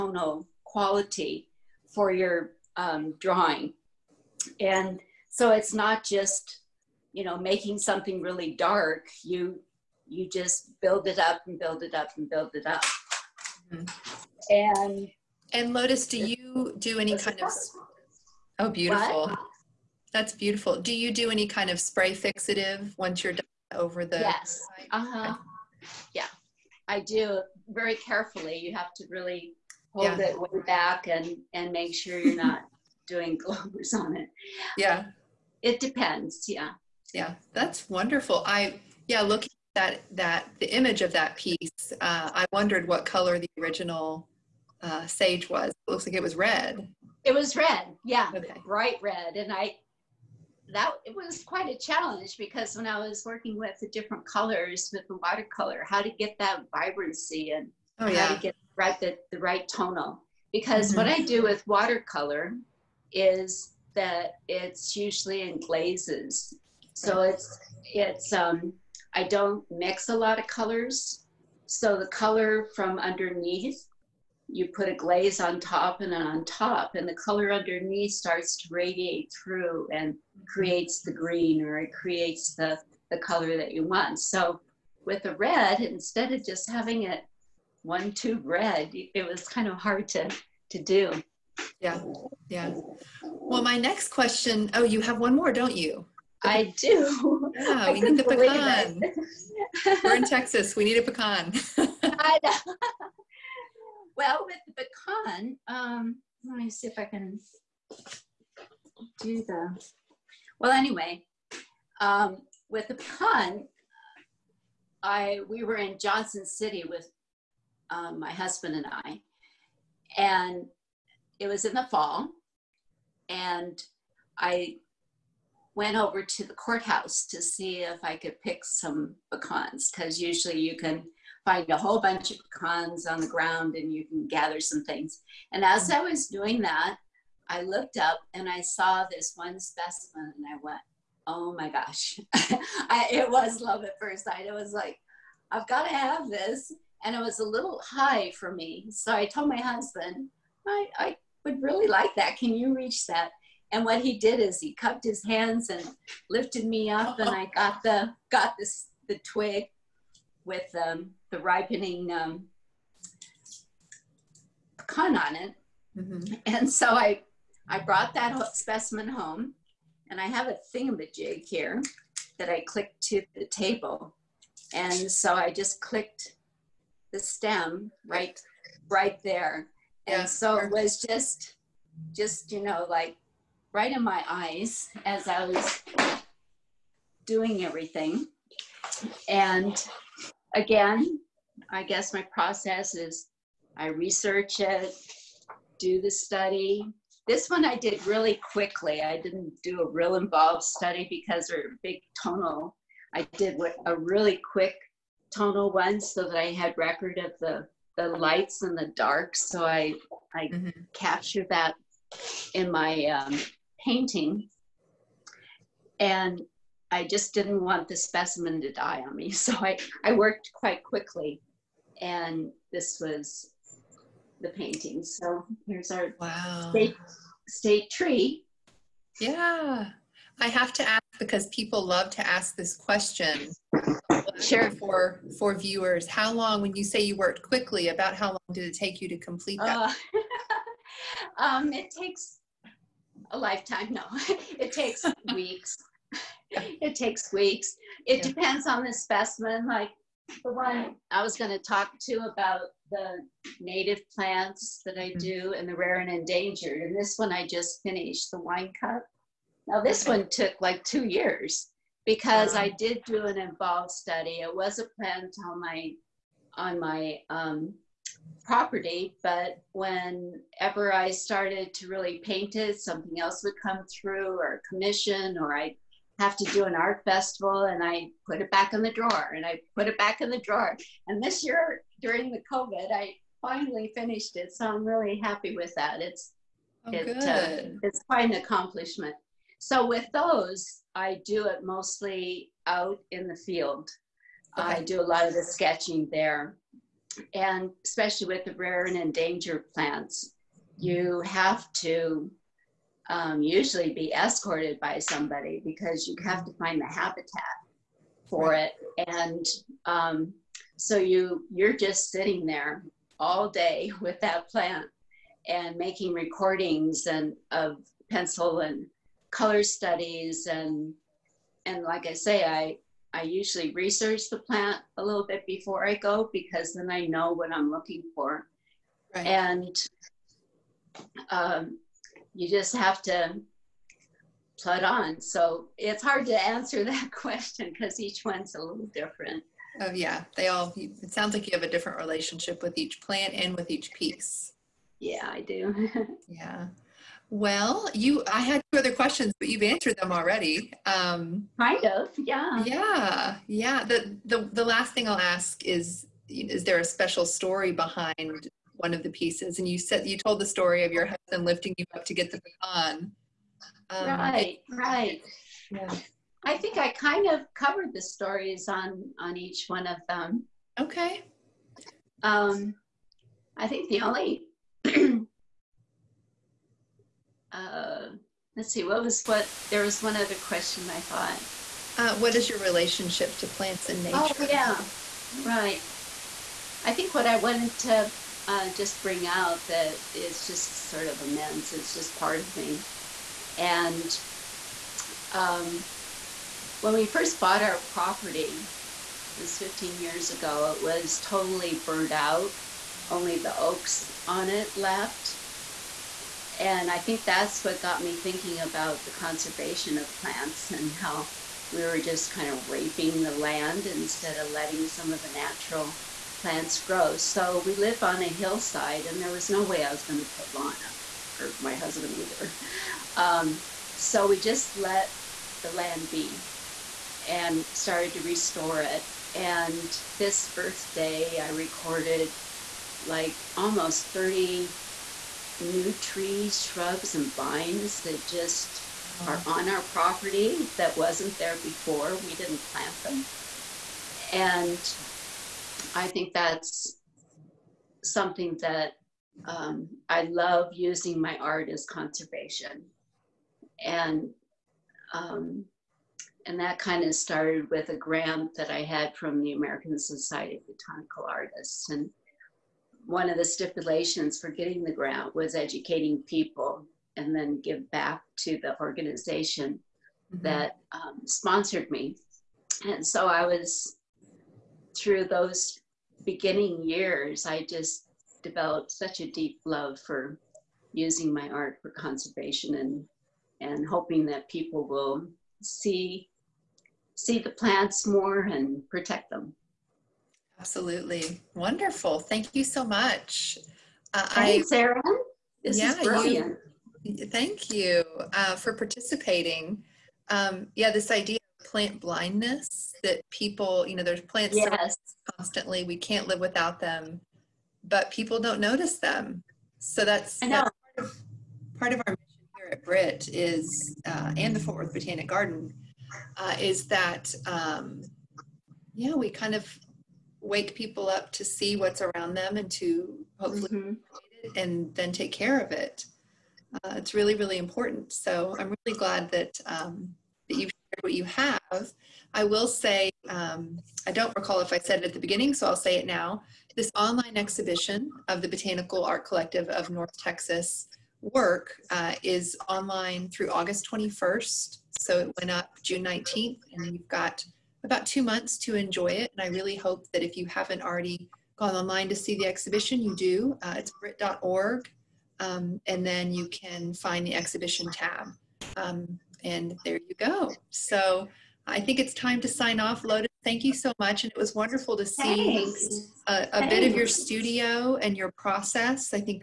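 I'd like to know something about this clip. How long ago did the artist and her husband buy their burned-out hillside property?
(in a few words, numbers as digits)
15 years.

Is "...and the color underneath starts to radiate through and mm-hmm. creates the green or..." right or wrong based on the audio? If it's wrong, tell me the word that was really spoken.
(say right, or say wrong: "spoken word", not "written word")
right.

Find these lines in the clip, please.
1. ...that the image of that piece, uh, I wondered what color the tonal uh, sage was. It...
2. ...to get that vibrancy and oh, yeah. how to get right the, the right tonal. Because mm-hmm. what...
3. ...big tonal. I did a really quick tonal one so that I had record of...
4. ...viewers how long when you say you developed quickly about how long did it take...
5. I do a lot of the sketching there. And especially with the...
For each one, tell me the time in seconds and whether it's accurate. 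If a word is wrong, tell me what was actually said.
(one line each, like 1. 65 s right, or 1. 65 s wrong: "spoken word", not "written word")
1. 40 s wrong: "original", not "tonal"
2. 56 s right
3. 201 s right
4. 235 s wrong: "worked", not "developed"
5. 294 s right.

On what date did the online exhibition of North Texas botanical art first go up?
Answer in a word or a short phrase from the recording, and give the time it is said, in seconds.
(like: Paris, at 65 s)
June 19th, at 545 s.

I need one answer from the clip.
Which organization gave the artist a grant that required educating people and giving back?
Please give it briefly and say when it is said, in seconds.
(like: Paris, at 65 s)
American Society of Botanical Artists, at 459 s.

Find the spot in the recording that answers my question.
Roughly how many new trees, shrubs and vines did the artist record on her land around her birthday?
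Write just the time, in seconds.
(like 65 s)
433 s.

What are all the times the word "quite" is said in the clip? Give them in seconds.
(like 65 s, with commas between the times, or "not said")
51 s, 220 s, 288 s.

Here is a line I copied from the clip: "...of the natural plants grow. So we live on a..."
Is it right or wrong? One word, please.
right.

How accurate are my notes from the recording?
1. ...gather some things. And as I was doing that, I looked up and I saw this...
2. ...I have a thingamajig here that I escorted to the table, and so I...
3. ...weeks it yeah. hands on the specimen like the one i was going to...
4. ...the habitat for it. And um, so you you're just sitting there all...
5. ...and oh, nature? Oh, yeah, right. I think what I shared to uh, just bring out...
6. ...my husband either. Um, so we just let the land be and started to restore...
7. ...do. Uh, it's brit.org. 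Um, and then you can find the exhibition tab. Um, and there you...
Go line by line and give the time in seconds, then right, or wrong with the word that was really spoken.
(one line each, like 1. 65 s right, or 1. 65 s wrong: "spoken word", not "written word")
1. 134 s right
2. 170 s wrong: "clicked", not "escorted"
3. 247 s wrong: "depends", not "hands"
4. 306 s right
5. 383 s wrong: "wanted", not "shared"
6. 421 s right
7. 553 s right.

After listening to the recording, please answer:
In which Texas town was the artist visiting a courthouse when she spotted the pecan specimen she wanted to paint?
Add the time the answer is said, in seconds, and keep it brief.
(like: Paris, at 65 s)
Johnson City, at 115 s.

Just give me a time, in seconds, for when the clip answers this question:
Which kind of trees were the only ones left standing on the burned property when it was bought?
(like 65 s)
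403 s.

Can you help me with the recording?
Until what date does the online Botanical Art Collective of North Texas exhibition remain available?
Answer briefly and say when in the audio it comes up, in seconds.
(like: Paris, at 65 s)
August 21st, at 543 s.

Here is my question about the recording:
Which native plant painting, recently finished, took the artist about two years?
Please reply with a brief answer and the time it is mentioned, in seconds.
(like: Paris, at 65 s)
Wine cup, at 258 s.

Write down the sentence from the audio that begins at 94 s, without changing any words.
Oh, you have one more, don't you?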